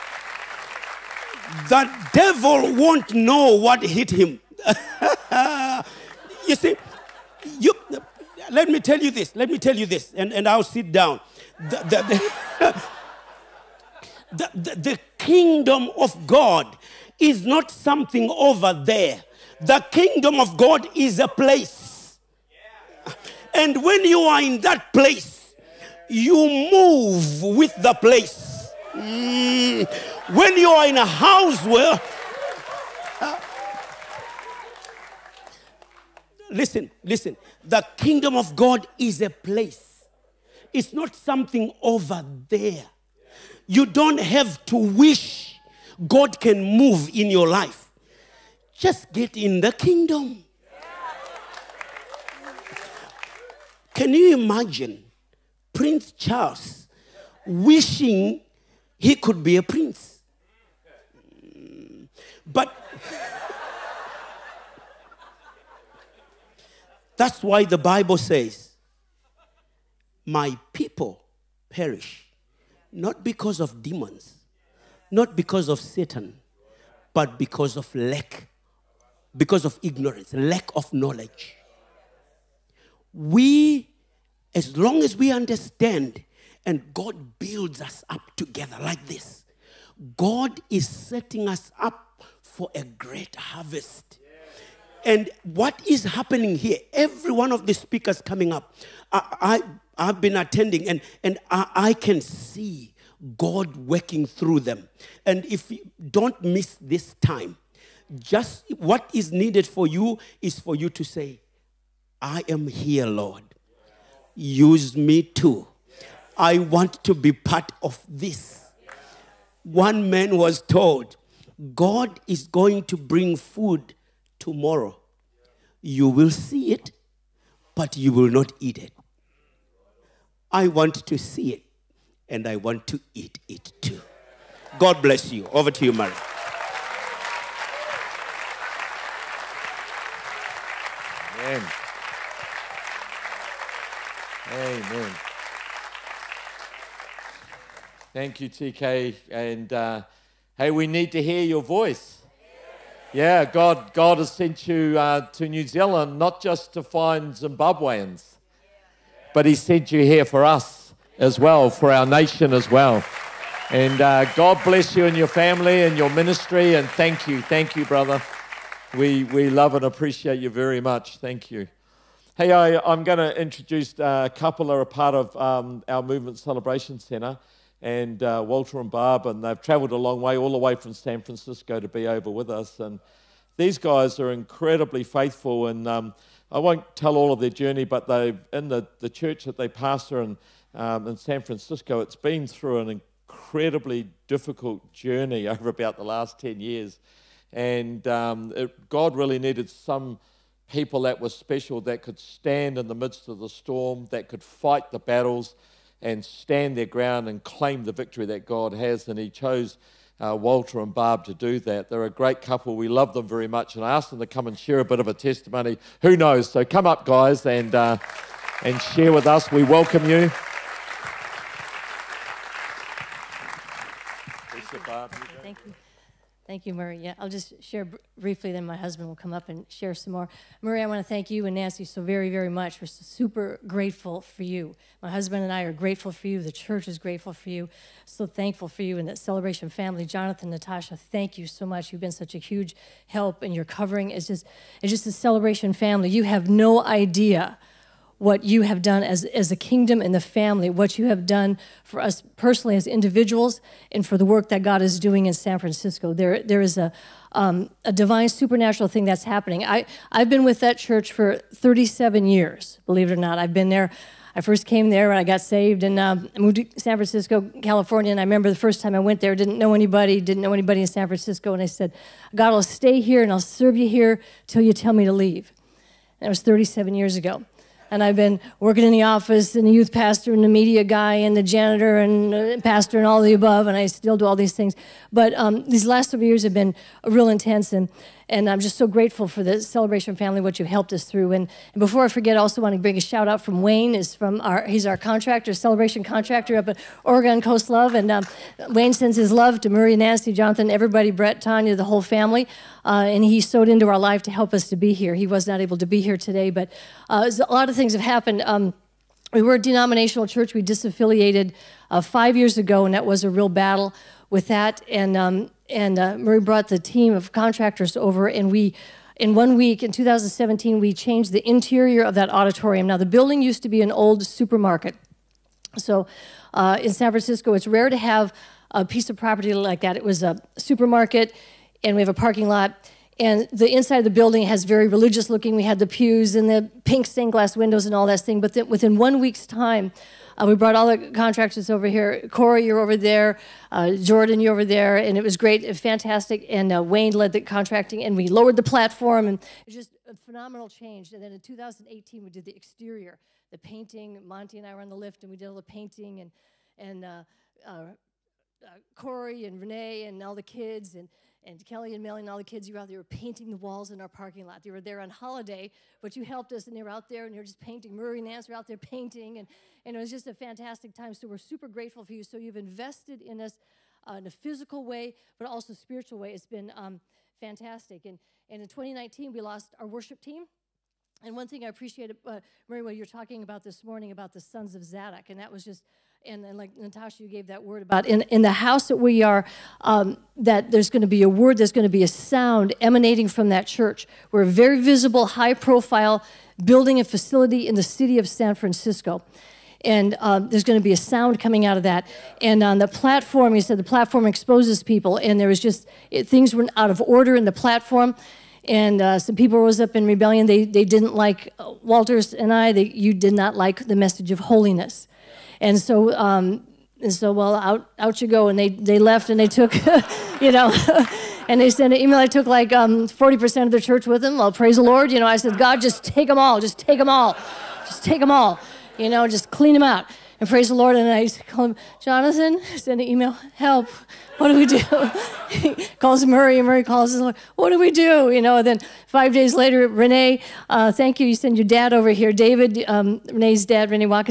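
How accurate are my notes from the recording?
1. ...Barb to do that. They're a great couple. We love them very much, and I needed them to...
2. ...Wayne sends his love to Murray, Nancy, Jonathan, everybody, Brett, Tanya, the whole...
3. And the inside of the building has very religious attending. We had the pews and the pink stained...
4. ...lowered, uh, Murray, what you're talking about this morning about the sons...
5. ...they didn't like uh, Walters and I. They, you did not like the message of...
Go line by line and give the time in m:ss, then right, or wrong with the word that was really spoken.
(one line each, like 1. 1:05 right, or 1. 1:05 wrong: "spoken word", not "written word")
1. 3:30 wrong: "asked", not "needed"
2. 4:58 right
3. 5:33 wrong: "looking", not "attending"
4. 6:21 wrong: "appreciated", not "lowered"
5. 6:50 right.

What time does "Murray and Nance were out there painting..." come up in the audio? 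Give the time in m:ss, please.
6:07.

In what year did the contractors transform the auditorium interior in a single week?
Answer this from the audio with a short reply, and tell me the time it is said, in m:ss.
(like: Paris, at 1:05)
2017, at 5:19.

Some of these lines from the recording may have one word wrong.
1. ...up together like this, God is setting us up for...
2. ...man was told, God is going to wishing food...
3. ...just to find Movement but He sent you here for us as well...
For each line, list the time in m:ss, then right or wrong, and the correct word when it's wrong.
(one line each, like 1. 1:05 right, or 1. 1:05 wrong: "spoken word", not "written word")
1. 1:28 right
2. 2:00 wrong: "bring", not "wishing"
3. 2:36 wrong: "Zimbabweans", not "Movement".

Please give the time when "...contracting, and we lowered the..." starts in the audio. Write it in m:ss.
5:47.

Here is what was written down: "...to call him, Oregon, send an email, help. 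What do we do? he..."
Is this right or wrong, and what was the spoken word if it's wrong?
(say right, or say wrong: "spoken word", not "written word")
wrong: "Jonathan", not "Oregon".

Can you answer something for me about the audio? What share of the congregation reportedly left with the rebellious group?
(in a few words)
40%.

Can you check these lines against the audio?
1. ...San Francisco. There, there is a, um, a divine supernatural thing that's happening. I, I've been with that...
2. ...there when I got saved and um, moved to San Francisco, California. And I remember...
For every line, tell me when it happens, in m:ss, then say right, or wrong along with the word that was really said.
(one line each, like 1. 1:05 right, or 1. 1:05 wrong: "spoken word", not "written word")
1. 4:15 right
2. 4:24 right.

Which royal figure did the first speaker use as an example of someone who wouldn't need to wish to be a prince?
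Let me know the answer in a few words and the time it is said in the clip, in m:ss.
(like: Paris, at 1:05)
Prince Charles, at 0:55.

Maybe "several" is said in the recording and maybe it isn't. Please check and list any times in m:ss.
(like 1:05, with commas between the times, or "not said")
4:46.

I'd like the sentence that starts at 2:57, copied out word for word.
And uh, Walter and Barb, and they've traveled a long way, all the way from San Francisco to be over with us.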